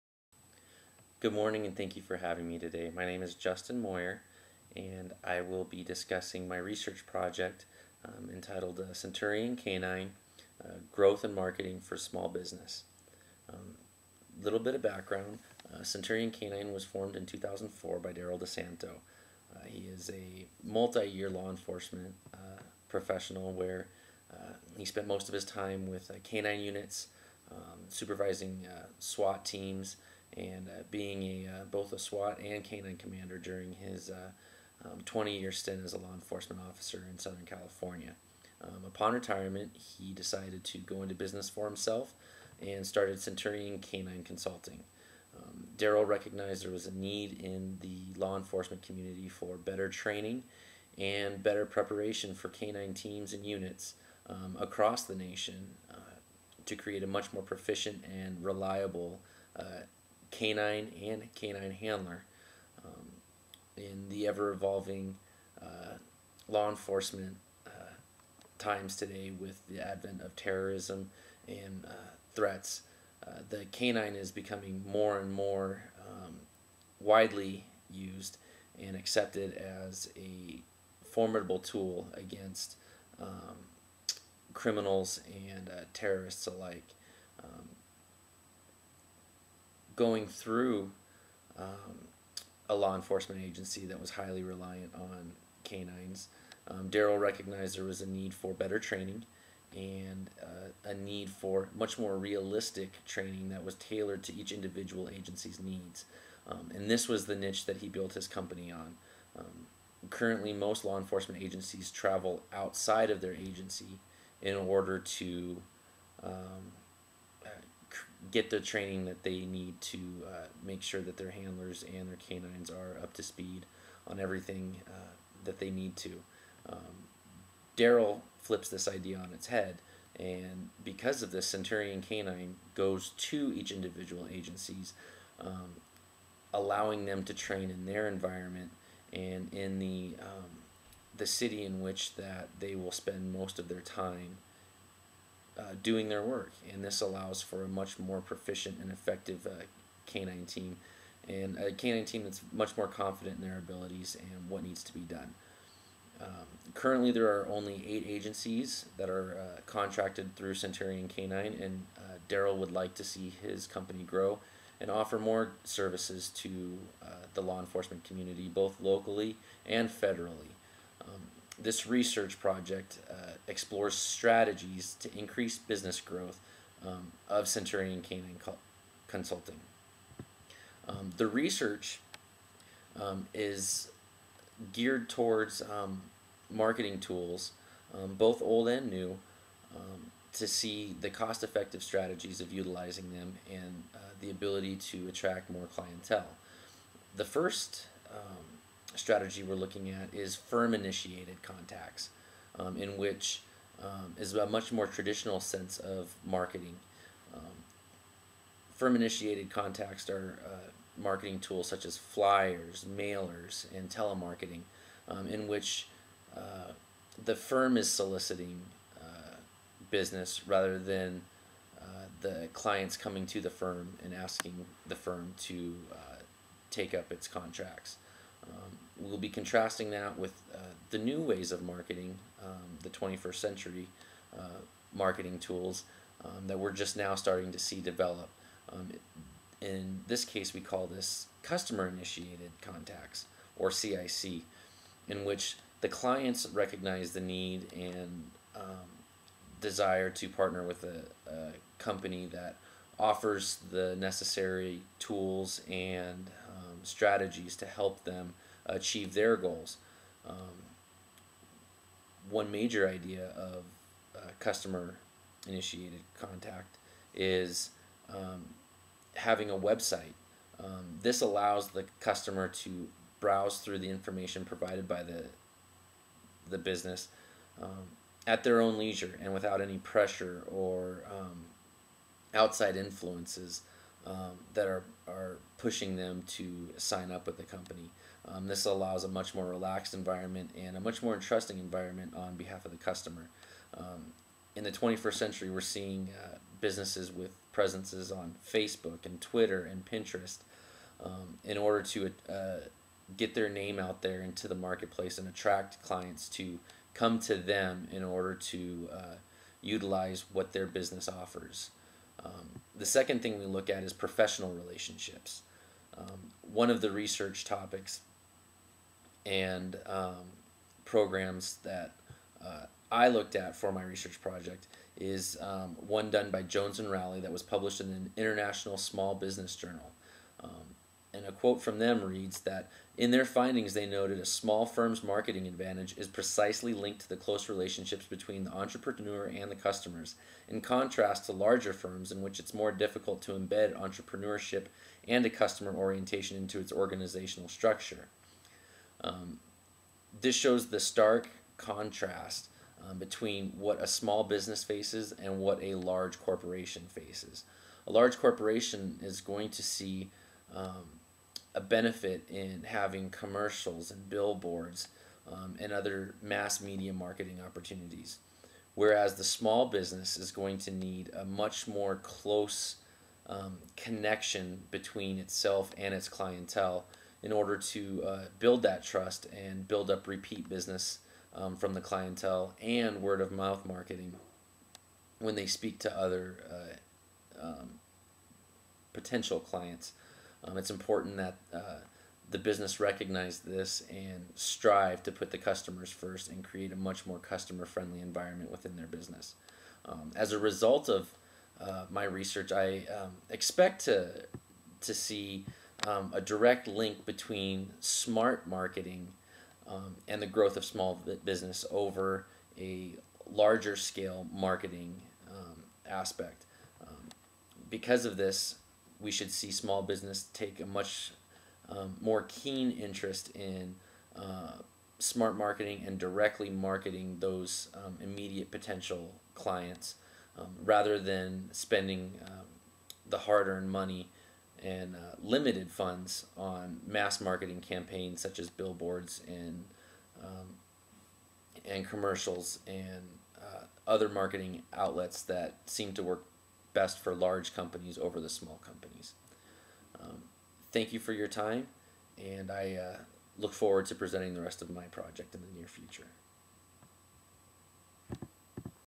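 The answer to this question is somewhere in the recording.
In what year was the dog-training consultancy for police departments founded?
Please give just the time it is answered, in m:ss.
0:17.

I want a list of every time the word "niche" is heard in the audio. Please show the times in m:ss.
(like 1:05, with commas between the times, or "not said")
1:47.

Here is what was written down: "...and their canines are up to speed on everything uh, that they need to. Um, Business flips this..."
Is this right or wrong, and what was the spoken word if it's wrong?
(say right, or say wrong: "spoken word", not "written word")
wrong: "Daryl", not "Business".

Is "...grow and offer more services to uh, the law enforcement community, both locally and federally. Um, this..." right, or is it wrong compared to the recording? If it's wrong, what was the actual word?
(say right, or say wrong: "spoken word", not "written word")
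right.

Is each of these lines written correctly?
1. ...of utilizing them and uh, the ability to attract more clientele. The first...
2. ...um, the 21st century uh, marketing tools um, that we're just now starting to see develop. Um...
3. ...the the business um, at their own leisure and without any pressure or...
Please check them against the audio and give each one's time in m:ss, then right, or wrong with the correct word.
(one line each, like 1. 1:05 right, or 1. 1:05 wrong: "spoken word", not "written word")
1. 3:12 right
2. 3:52 right
3. 4:35 right.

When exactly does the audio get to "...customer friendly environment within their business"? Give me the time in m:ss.
6:37.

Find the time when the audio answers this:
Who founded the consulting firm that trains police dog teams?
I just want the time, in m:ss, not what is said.
0:18.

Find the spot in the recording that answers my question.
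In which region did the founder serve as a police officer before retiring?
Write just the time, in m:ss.
0:37.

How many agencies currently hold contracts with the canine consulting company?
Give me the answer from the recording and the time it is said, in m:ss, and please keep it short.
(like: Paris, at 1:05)
8, at 2:37.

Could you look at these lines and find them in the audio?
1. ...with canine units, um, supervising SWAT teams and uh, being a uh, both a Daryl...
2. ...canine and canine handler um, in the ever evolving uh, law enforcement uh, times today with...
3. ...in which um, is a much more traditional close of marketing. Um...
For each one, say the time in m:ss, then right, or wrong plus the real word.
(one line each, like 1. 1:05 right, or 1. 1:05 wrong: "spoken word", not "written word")
1. 0:25 wrong: "SWAT", not "Daryl"
2. 1:00 right
3. 3:22 wrong: "sense", not "close".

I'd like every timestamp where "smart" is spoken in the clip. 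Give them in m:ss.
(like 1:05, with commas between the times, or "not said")
6:47, 7:04.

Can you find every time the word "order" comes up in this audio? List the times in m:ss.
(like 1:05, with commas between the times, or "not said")
1:54, 5:01, 5:08, 6:17.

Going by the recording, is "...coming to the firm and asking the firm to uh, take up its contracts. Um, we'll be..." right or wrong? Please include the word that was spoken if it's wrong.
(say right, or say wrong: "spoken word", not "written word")
right.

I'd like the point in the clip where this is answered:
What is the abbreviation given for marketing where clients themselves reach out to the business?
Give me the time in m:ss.
4:03.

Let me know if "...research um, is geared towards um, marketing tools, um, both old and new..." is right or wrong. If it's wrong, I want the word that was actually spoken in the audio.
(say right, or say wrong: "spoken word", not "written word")
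right.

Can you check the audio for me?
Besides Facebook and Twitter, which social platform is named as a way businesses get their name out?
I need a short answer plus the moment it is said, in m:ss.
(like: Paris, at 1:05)
Pinterest, at 4:59.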